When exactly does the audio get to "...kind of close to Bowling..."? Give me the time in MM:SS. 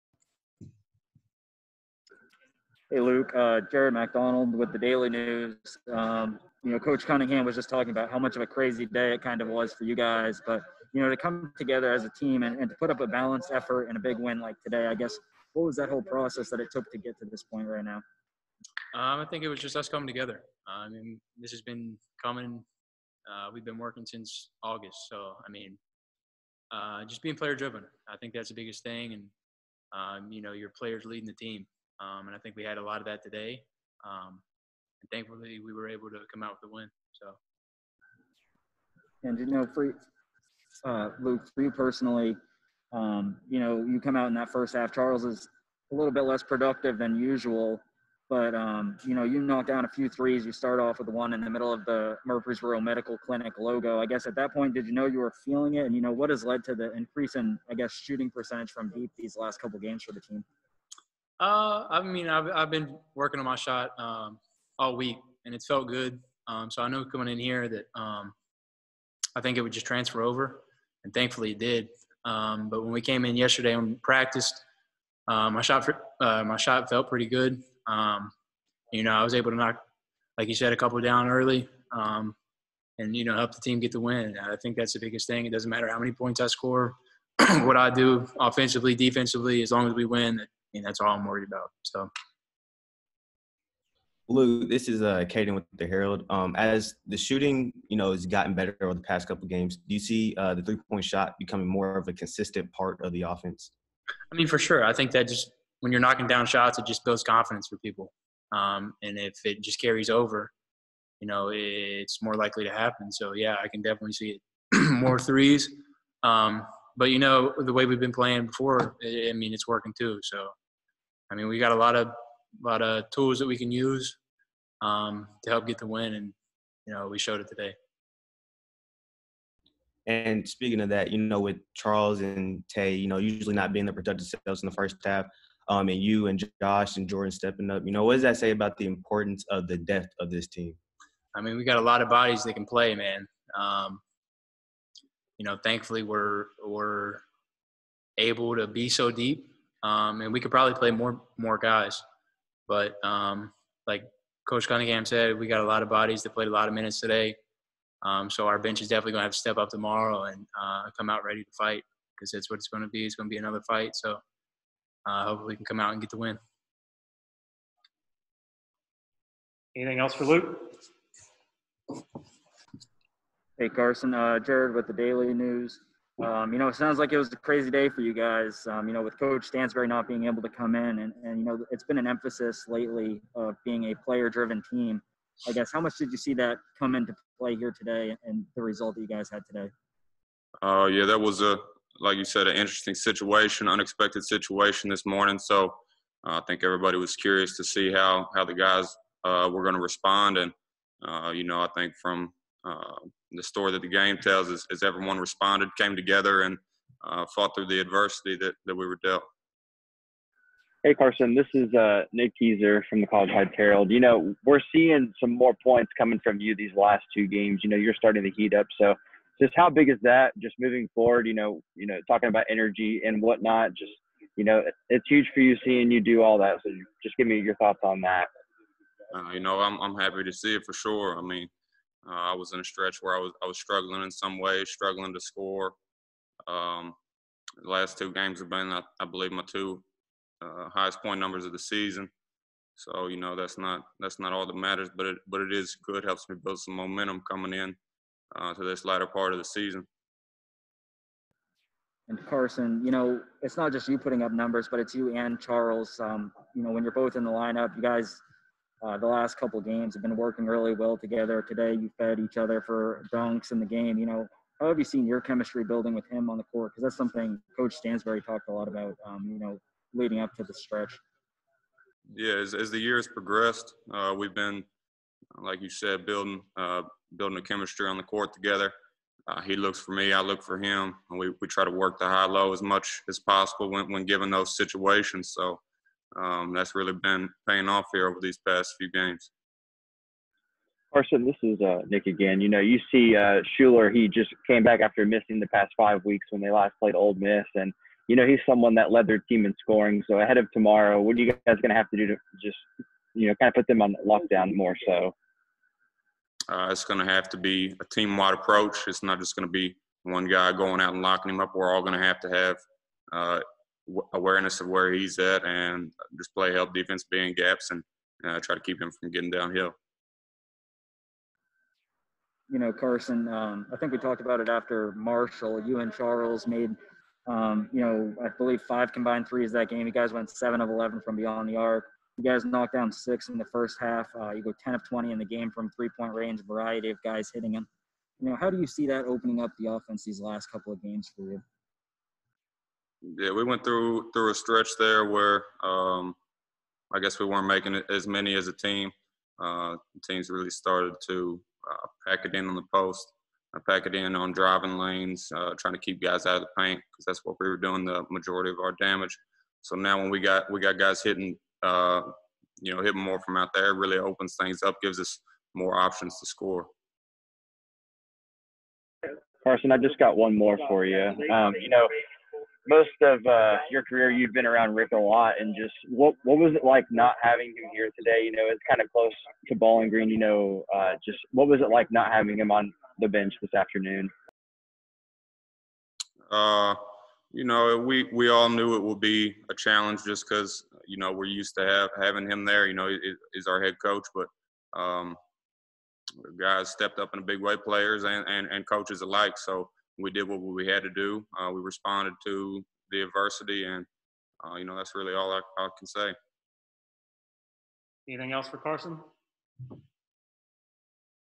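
06:18.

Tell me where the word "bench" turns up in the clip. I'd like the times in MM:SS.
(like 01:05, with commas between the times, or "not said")
02:38, 06:23.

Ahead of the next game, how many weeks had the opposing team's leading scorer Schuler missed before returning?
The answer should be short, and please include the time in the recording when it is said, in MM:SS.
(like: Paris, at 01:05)
5 weeks, at 04:55.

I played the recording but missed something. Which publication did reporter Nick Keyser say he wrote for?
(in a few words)
College Heights Herald.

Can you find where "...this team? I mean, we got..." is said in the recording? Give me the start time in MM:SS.
02:20.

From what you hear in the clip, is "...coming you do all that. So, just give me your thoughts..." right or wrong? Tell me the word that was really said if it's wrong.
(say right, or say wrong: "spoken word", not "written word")
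wrong: "seeing", not "coming".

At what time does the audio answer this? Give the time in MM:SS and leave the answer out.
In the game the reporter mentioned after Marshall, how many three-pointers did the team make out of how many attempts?
05:34.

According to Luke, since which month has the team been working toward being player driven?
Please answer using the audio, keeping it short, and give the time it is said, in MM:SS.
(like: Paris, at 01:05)
August, at 00:24.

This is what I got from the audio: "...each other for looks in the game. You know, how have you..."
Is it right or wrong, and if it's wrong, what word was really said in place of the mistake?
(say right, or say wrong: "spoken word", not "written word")
wrong: "dunks", not "looks".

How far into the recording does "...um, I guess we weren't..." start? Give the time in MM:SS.
05:45.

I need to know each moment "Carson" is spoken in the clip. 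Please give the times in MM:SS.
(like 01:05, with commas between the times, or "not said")
02:53, 03:30, 04:12, 04:50, 05:22, 06:09, 06:48.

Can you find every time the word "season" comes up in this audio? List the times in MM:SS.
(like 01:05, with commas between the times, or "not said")
04:01, 04:09.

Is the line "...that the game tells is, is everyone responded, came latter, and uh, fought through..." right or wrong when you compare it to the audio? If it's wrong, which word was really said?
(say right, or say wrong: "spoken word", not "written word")
wrong: "together", not "latter".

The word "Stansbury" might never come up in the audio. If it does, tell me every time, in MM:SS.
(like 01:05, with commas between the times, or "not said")
02:59, 04:27.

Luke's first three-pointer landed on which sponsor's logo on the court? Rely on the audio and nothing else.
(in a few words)
Murfreesboro Medical Clinic.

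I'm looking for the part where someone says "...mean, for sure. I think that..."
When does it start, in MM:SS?
01:44.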